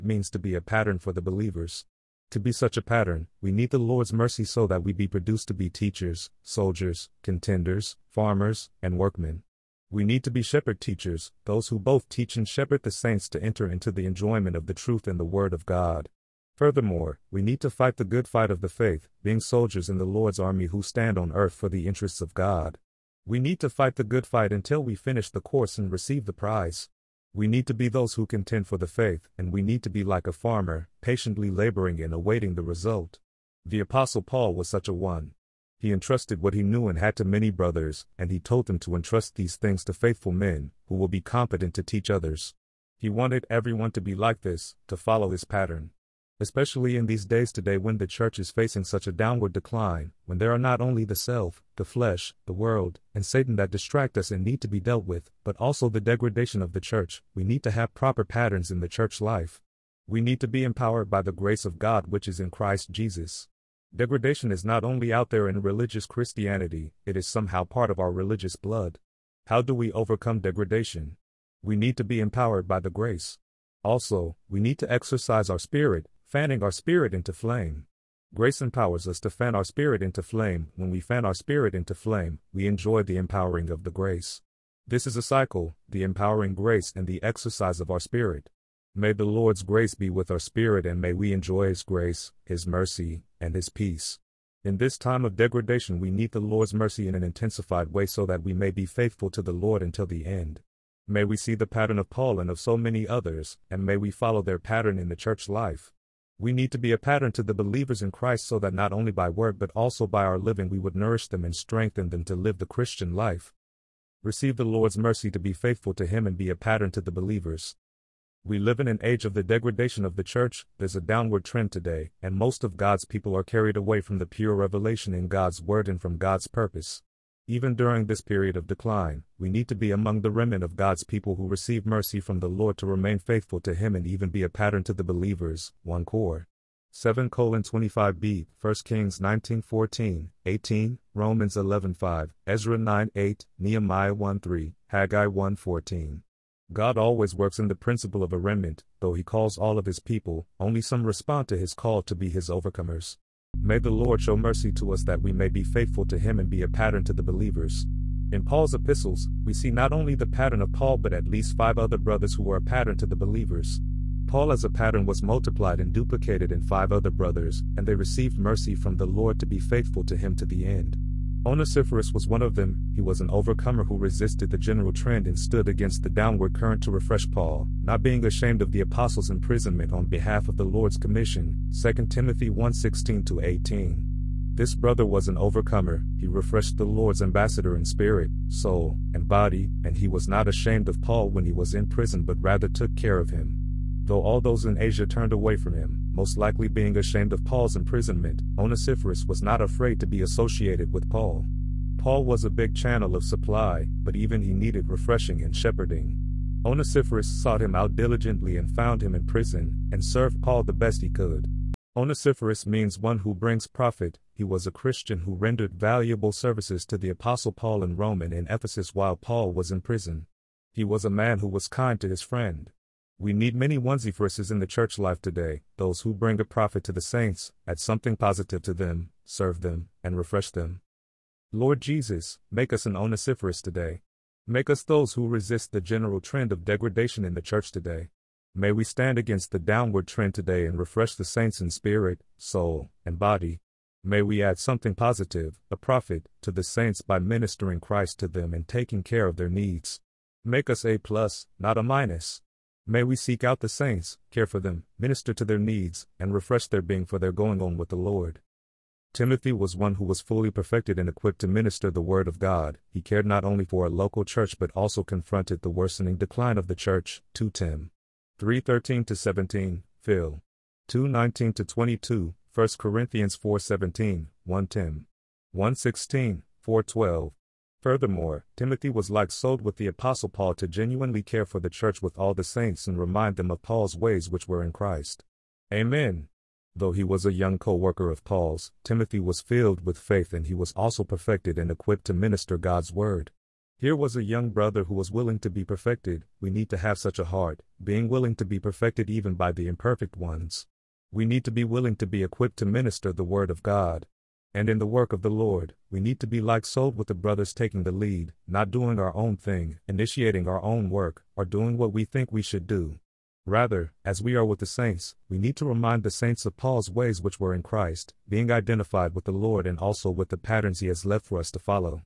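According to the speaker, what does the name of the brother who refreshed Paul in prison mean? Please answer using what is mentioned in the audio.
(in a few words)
One who brings profit.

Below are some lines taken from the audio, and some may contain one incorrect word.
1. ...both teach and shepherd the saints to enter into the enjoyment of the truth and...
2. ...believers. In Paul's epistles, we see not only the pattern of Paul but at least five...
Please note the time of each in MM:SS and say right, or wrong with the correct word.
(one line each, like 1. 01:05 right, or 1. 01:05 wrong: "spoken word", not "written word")
1. 00:11 right
2. 02:37 right.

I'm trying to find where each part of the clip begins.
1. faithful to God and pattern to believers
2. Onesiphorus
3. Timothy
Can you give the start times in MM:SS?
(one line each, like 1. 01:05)
1. 01:53
2. 02:51
3. 04:18.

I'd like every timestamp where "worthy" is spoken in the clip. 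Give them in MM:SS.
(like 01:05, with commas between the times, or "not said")
not said.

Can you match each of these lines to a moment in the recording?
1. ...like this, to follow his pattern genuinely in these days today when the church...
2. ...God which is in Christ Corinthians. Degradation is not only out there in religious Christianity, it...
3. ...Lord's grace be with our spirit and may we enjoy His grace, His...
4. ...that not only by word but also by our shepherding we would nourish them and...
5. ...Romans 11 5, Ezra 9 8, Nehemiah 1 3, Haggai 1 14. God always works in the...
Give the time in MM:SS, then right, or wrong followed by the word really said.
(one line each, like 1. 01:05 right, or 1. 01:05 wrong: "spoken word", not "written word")
1. 00:44 wrong: "especially", not "genuinely"
2. 01:01 wrong: "Jesus", not "Corinthians"
3. 01:29 right
4. 01:48 wrong: "living", not "shepherding"
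5. 02:21 right.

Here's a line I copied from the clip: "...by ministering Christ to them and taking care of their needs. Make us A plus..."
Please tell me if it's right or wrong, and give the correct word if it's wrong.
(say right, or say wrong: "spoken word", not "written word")
right.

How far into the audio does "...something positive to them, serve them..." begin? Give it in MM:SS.
03:47.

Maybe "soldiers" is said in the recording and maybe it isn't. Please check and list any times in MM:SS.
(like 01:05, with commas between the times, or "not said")
00:06, 00:19.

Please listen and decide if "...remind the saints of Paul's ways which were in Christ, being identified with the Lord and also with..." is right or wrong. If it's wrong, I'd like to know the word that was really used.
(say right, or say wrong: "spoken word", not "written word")
right.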